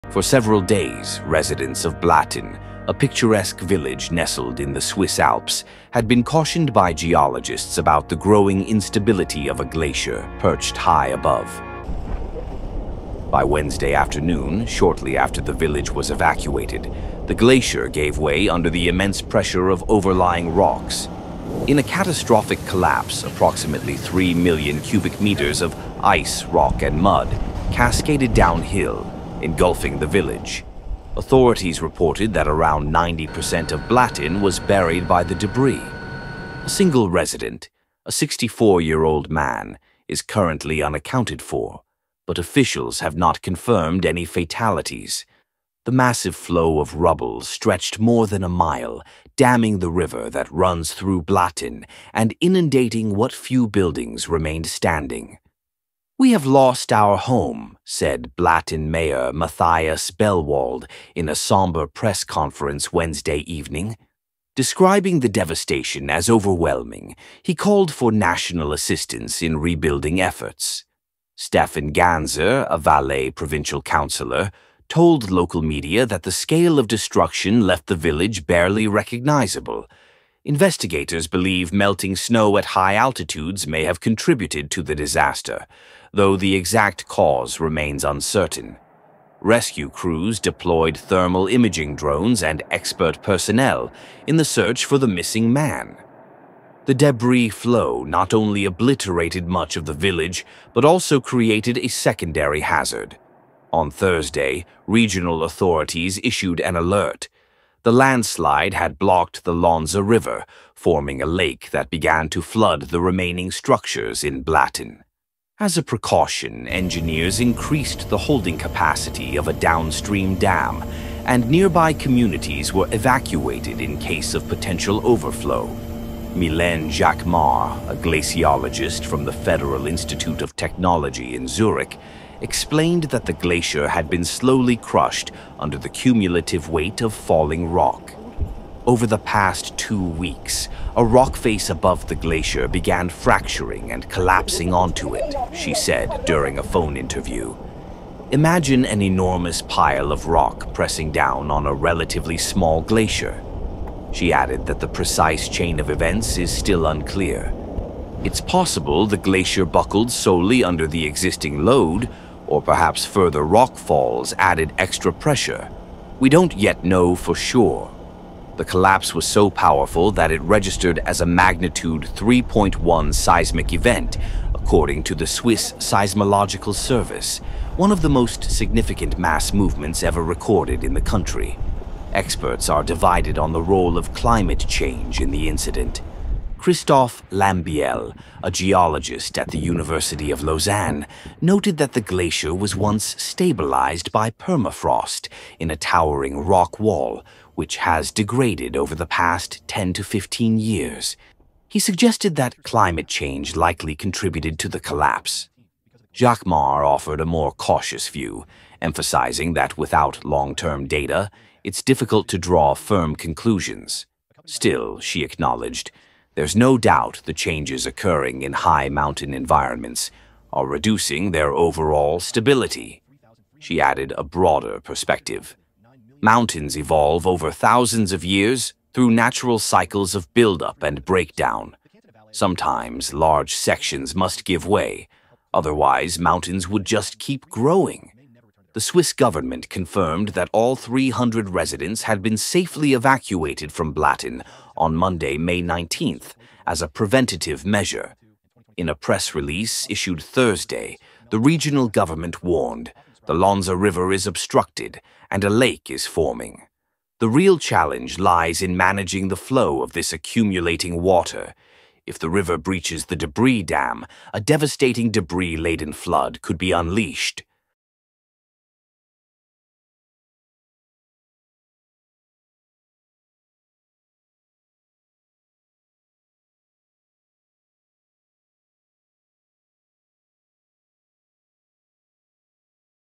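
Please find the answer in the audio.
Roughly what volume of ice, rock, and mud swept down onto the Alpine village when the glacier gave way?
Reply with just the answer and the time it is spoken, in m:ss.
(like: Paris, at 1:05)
3 million cubic meters, at 0:23.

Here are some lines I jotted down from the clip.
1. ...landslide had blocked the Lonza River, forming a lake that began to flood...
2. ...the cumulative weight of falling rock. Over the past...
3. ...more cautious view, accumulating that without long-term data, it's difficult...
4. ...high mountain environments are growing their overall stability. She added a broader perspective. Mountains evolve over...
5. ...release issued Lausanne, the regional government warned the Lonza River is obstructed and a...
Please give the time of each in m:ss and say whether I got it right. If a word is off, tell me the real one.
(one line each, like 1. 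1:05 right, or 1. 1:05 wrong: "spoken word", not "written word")
1. 1:47 right
2. 2:15 right
3. 3:27 wrong: "emphasizing", not "accumulating"
4. 3:38 wrong: "reducing", not "growing"
5. 4:09 wrong: "Thursday", not "Lausanne".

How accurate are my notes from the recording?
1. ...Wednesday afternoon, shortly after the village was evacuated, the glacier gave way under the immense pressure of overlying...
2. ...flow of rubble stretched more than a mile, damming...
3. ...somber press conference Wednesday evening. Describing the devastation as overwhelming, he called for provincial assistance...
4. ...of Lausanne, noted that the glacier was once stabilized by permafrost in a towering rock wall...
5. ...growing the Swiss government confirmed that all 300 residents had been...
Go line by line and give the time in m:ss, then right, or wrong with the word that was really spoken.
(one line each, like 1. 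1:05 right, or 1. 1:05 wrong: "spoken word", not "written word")
1. 0:13 right
2. 0:46 right
3. 1:01 wrong: "national", not "provincial"
4. 3:10 right
5. 3:57 right.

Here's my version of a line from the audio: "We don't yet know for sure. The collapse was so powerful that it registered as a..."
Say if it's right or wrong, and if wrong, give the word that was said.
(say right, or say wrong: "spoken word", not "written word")
right.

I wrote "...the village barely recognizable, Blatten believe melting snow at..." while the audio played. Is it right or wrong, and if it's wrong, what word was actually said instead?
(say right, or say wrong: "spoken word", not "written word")
wrong: "Investigators", not "Blatten".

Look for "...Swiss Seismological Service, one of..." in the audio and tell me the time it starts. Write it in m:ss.
2:55.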